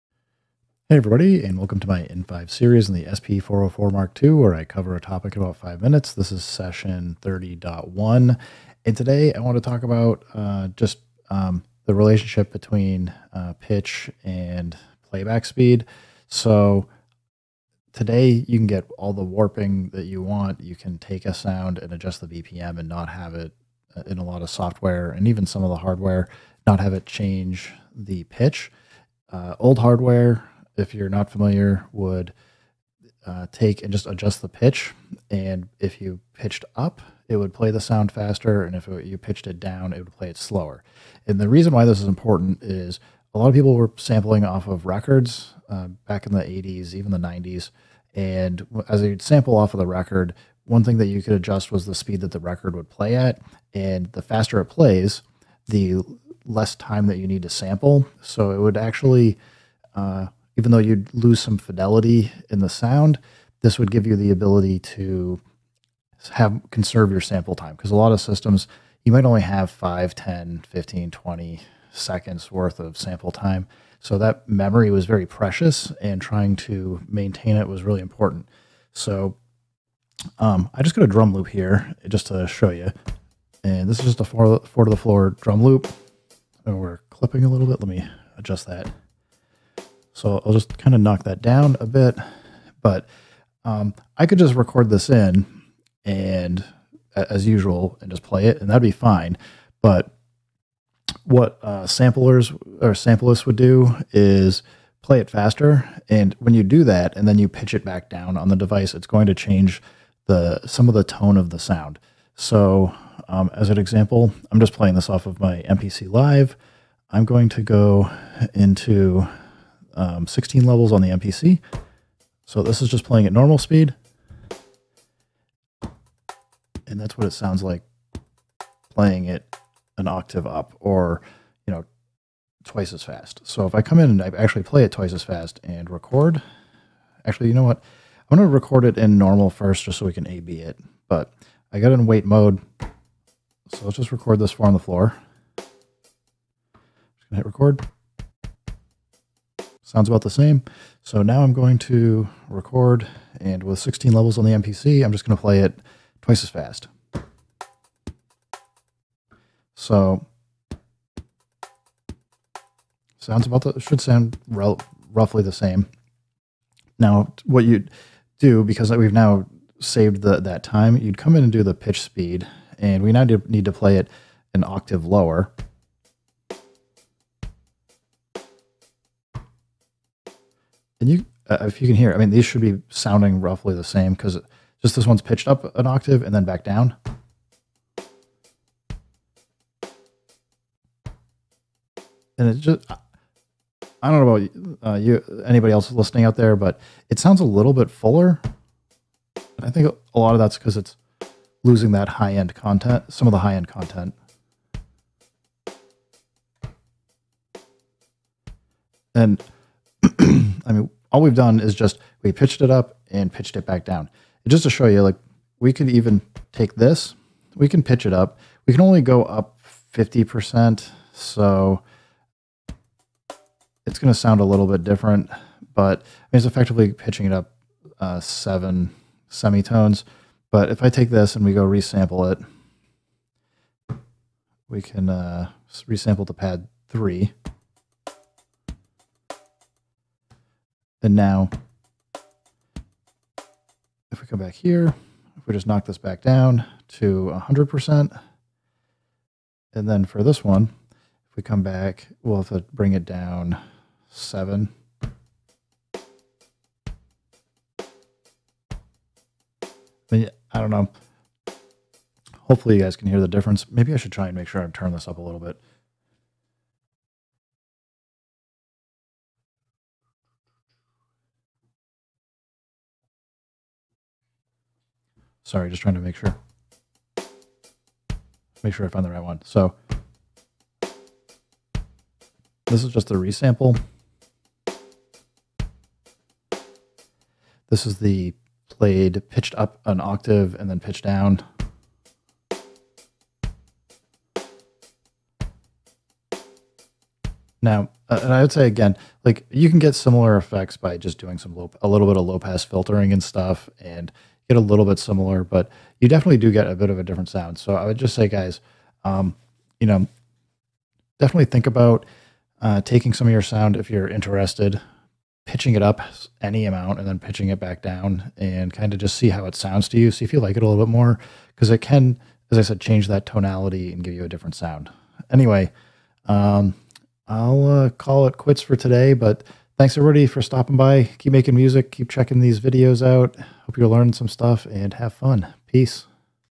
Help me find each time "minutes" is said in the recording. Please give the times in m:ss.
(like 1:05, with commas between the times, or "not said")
0:05.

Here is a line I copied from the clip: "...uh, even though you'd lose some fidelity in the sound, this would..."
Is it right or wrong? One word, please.
right.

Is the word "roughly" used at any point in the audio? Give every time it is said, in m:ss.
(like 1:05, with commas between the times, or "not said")
2:44, 3:03.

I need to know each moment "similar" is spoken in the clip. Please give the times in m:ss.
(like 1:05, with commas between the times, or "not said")
4:59, 5:04.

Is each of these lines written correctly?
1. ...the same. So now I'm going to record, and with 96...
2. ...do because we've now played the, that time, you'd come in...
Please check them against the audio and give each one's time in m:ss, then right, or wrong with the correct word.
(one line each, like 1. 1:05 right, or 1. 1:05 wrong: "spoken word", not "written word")
1. 2:30 wrong: "16", not "96"
2. 2:48 wrong: "saved", not "played".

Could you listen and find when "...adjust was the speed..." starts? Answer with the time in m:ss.
0:51.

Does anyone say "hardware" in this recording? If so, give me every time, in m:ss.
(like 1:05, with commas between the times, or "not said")
0:25, 0:29.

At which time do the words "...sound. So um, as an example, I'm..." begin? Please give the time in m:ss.
1:51.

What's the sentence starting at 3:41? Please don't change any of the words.
So it's going to sound a little bit different, but I mean, it's effectively pitching it up uh, seven semitones.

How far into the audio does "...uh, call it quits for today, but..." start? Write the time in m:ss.
5:27.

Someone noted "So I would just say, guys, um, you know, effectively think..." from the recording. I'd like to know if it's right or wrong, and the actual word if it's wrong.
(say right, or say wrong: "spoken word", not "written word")
wrong: "definitely", not "effectively".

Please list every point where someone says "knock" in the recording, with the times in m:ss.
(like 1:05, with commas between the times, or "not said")
1:31, 4:05.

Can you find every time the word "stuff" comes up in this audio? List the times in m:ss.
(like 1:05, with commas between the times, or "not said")
5:03, 5:34.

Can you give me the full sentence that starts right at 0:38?
And if it, you pitched it down, it would play it slower.